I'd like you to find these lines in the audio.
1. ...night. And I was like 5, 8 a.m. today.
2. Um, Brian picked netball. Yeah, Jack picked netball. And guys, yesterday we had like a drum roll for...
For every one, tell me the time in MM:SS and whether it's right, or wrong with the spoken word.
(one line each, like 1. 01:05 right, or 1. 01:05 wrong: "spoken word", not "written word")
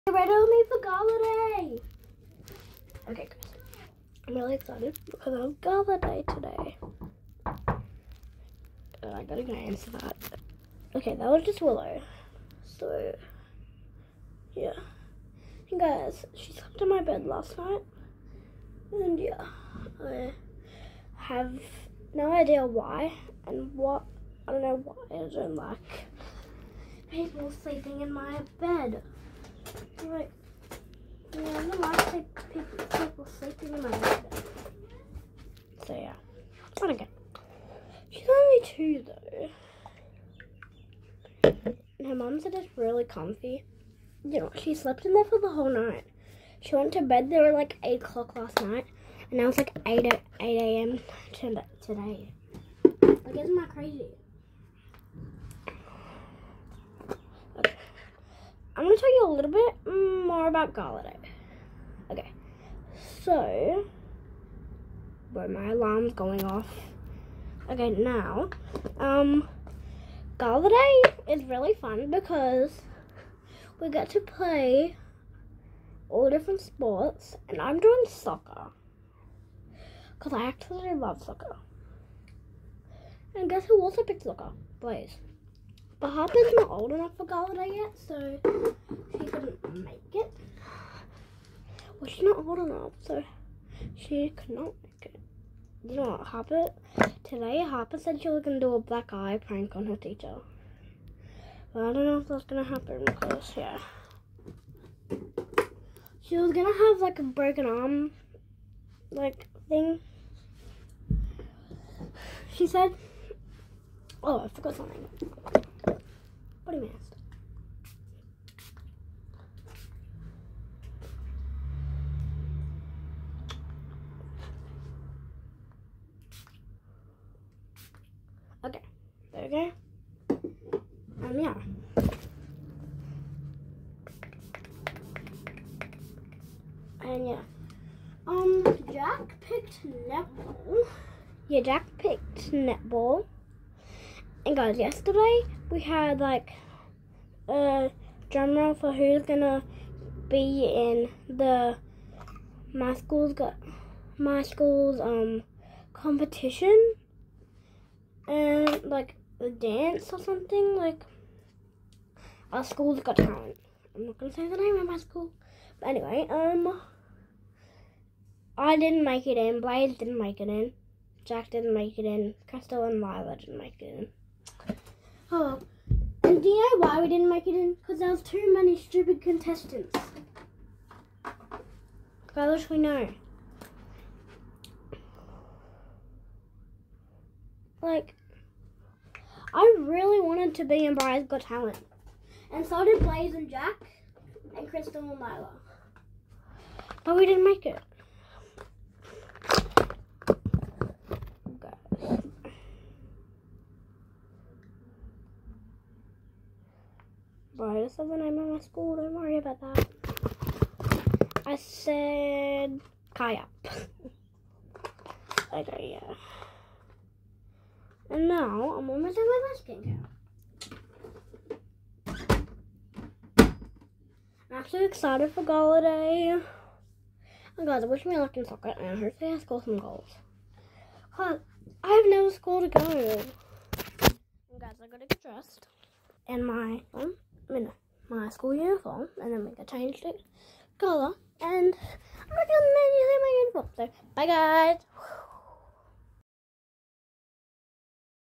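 1. 00:48 wrong: "8", not "5"
2. 02:18 wrong: "Jack", not "Brian".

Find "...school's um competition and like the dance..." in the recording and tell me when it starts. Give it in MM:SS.
02:34.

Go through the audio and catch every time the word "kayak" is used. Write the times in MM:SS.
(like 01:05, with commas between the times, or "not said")
03:33.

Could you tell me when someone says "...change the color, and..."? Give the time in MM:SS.
03:59.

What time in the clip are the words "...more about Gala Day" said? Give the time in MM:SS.
01:00.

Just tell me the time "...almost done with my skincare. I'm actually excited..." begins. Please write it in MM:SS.
03:38.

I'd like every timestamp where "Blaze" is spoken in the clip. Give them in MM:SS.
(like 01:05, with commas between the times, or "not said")
01:24, 02:49, 03:13.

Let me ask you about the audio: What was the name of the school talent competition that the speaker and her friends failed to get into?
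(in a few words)
Brian's Got Talent.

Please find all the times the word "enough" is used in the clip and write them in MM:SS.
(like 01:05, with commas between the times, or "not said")
01:26, 01:32.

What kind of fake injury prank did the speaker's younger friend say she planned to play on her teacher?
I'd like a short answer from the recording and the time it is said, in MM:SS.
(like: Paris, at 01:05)
Black eye, at 01:38.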